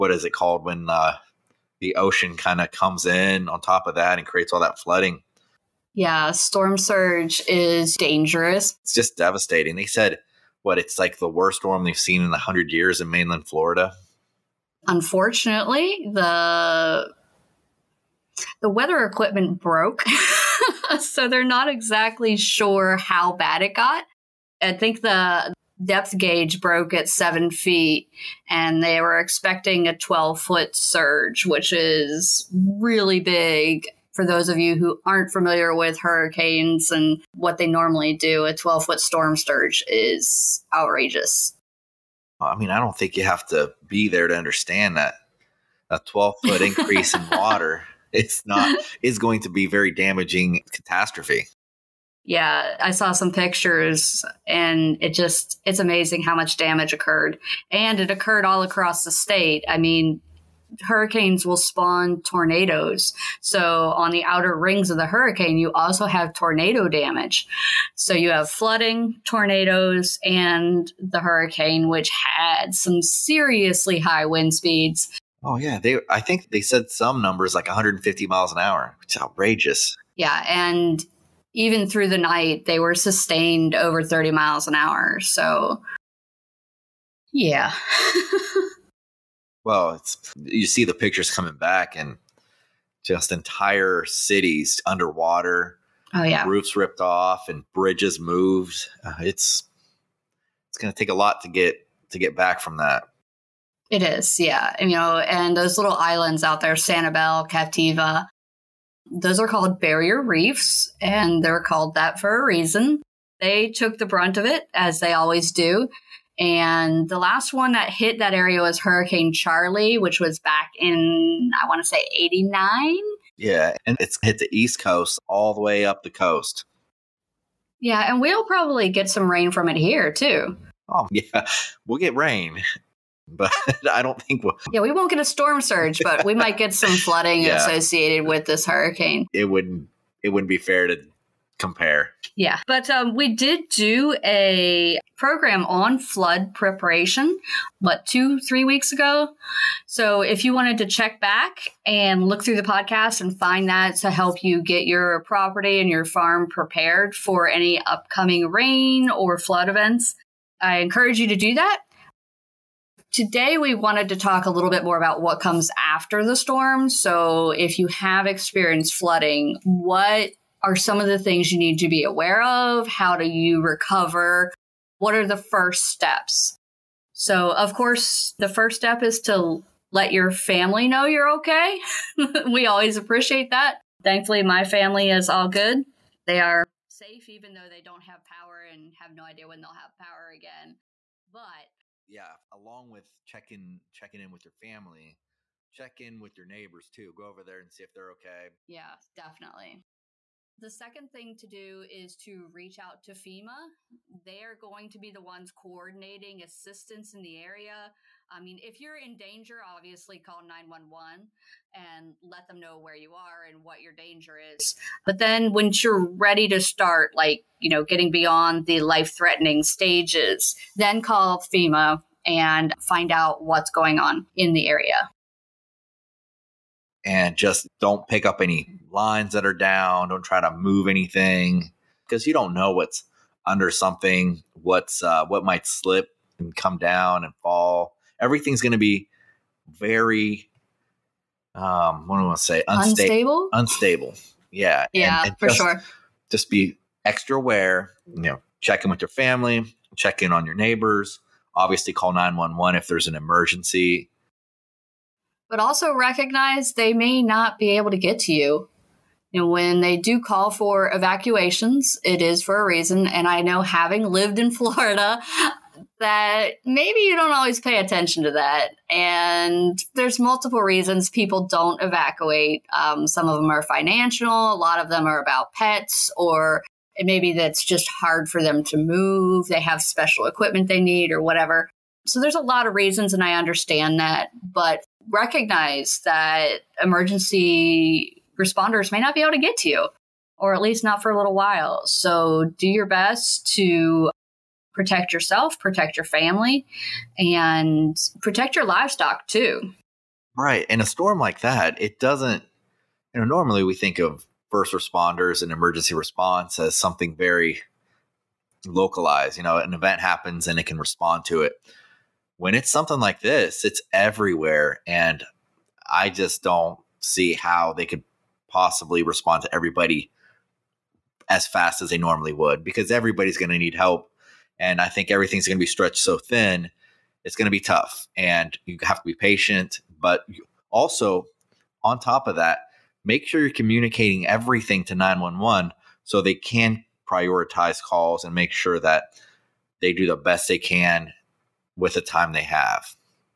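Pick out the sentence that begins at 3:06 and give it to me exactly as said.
They are safe, even though they don't have power and have no idea when they'll have power again.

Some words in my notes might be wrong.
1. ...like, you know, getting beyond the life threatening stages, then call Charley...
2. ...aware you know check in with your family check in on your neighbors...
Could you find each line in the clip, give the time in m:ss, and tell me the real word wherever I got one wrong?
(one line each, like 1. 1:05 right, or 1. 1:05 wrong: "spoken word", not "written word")
1. 3:37 wrong: "FEMA", not "Charley"
2. 4:07 right.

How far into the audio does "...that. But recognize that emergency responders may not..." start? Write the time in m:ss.
4:43.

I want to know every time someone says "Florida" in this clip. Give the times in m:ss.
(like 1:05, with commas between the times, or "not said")
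0:13, 4:24.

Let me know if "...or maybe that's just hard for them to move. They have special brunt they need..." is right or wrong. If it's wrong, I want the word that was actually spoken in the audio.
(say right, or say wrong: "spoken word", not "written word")
wrong: "equipment", not "brunt".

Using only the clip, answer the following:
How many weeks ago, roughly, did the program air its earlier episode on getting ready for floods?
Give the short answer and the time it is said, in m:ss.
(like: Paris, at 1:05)
2 to 3 weeks, at 2:28.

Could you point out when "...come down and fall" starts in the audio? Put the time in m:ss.
3:56.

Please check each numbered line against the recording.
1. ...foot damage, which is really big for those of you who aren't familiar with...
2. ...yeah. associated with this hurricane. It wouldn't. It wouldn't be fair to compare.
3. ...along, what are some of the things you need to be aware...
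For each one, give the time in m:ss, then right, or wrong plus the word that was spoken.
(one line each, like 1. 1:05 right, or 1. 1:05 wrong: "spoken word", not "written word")
1. 0:30 wrong: "surge", not "damage"
2. 2:17 right
3. 2:48 wrong: "flooding", not "along".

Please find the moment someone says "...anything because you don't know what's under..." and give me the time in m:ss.
3:50.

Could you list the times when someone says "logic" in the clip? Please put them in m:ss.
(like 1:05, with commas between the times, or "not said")
not said.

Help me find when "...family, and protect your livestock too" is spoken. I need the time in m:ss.
4:56.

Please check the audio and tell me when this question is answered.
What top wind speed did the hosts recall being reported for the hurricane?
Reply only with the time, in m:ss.
1:17.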